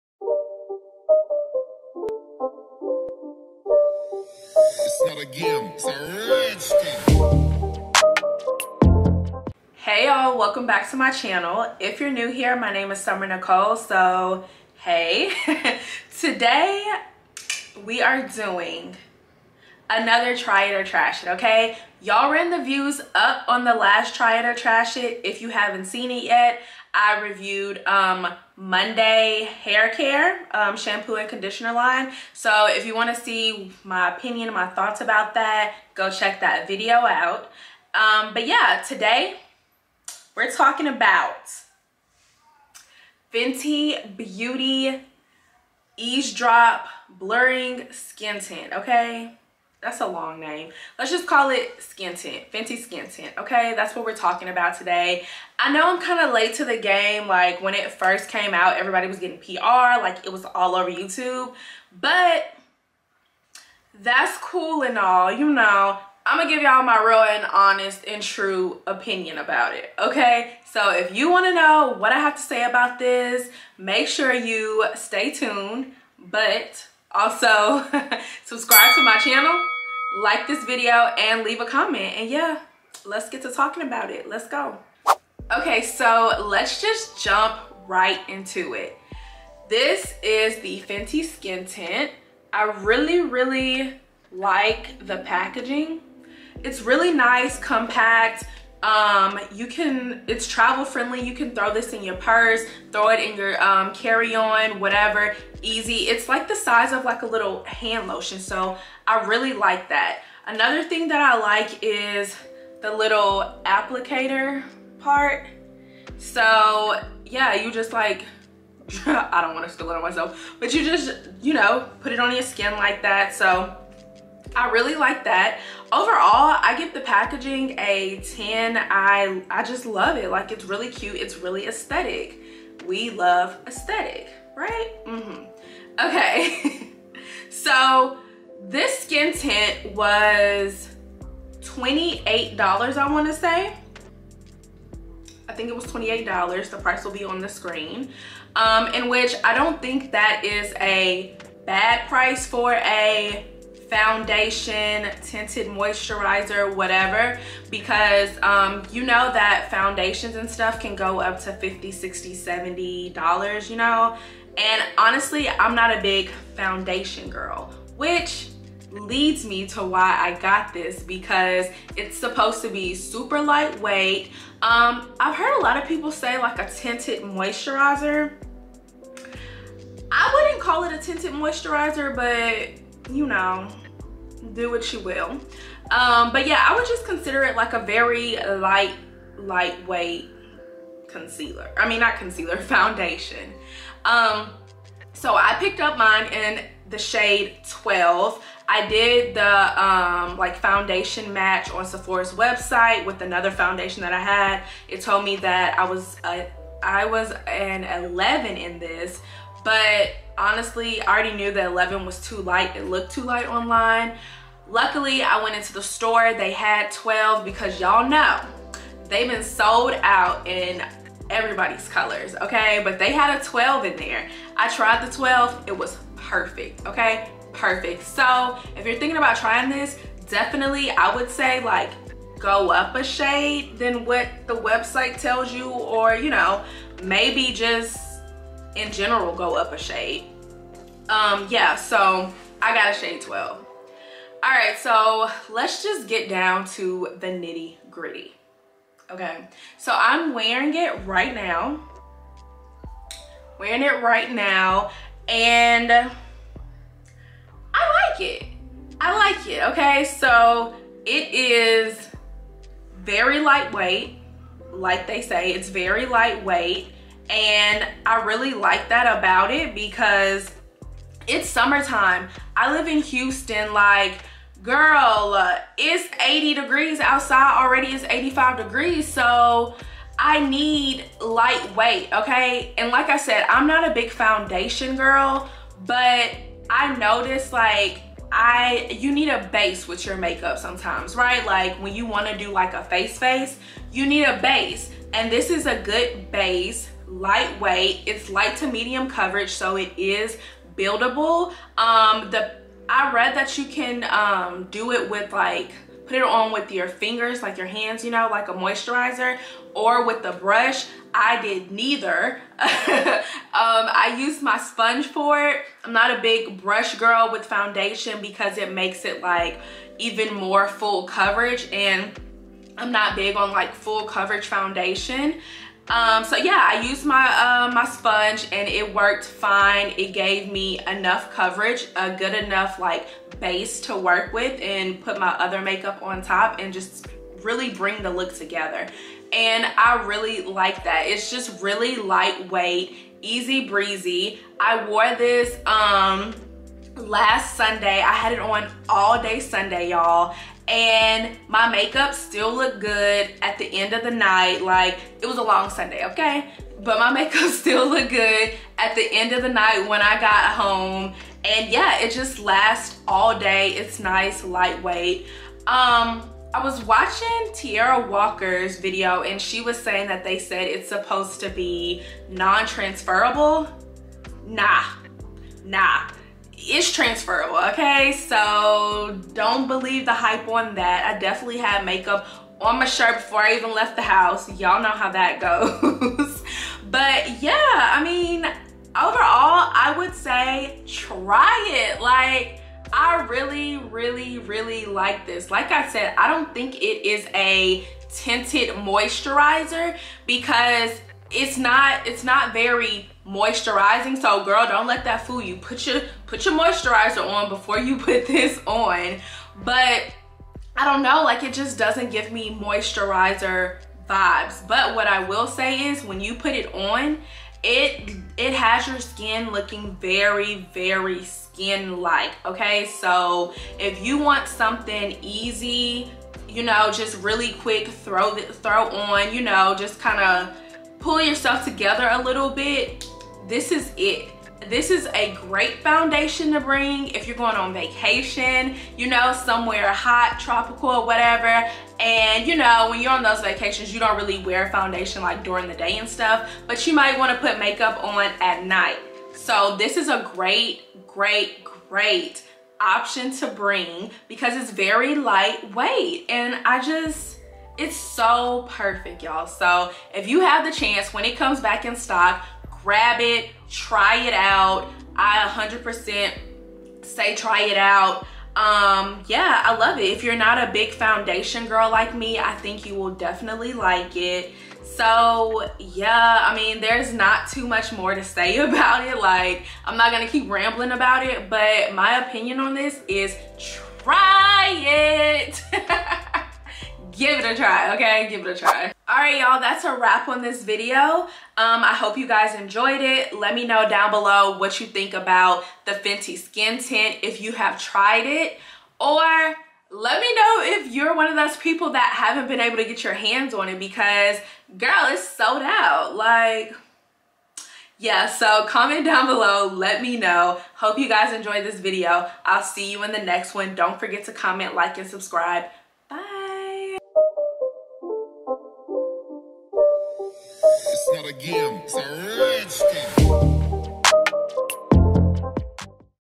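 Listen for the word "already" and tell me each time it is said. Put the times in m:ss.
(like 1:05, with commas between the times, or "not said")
3:31, 4:37.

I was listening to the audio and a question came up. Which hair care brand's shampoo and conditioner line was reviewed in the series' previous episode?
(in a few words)
Monday.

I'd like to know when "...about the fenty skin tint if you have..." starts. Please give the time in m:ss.
8:15.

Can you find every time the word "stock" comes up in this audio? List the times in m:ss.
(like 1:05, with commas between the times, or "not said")
7:41.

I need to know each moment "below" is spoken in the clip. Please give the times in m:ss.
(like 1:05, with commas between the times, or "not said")
8:14, 8:29.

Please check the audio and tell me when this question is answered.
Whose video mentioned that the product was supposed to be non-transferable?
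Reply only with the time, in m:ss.
6:07.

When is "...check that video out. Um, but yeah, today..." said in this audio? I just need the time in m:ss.
0:36.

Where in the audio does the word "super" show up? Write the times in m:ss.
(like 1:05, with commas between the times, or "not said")
2:52.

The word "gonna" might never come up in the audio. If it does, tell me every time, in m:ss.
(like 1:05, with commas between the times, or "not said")
1:06, 8:00.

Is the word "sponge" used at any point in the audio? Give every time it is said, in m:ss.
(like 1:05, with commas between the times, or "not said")
5:14, 5:27.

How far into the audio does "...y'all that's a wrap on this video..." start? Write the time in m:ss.
8:09.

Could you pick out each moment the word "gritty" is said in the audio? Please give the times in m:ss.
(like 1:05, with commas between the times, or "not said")
4:07.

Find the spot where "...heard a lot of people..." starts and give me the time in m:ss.
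2:55.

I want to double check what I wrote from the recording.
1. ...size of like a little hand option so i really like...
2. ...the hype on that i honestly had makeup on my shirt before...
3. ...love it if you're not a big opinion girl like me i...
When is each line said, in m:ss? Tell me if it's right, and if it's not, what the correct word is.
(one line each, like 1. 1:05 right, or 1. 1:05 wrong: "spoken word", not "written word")
1. 1:46 wrong: "lotion", not "option"
2. 6:20 wrong: "definitely", not "honestly"
3. 7:49 wrong: "foundation", not "opinion".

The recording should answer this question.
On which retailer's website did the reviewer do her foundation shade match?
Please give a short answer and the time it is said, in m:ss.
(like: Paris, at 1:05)
Sephora, at 3:21.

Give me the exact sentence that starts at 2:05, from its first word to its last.
Overall, I give the packaging a 10.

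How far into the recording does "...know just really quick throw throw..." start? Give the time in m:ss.
7:06.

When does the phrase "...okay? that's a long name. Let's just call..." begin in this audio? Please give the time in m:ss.
0:48.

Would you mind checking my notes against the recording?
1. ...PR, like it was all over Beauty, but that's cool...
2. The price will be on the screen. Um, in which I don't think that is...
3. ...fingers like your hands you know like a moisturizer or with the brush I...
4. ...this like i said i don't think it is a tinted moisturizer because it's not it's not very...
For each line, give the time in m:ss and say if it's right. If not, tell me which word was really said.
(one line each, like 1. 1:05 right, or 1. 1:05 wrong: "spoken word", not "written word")
1. 0:59 wrong: "YouTube", not "Beauty"
2. 2:26 right
3. 5:06 right
4. 6:35 right.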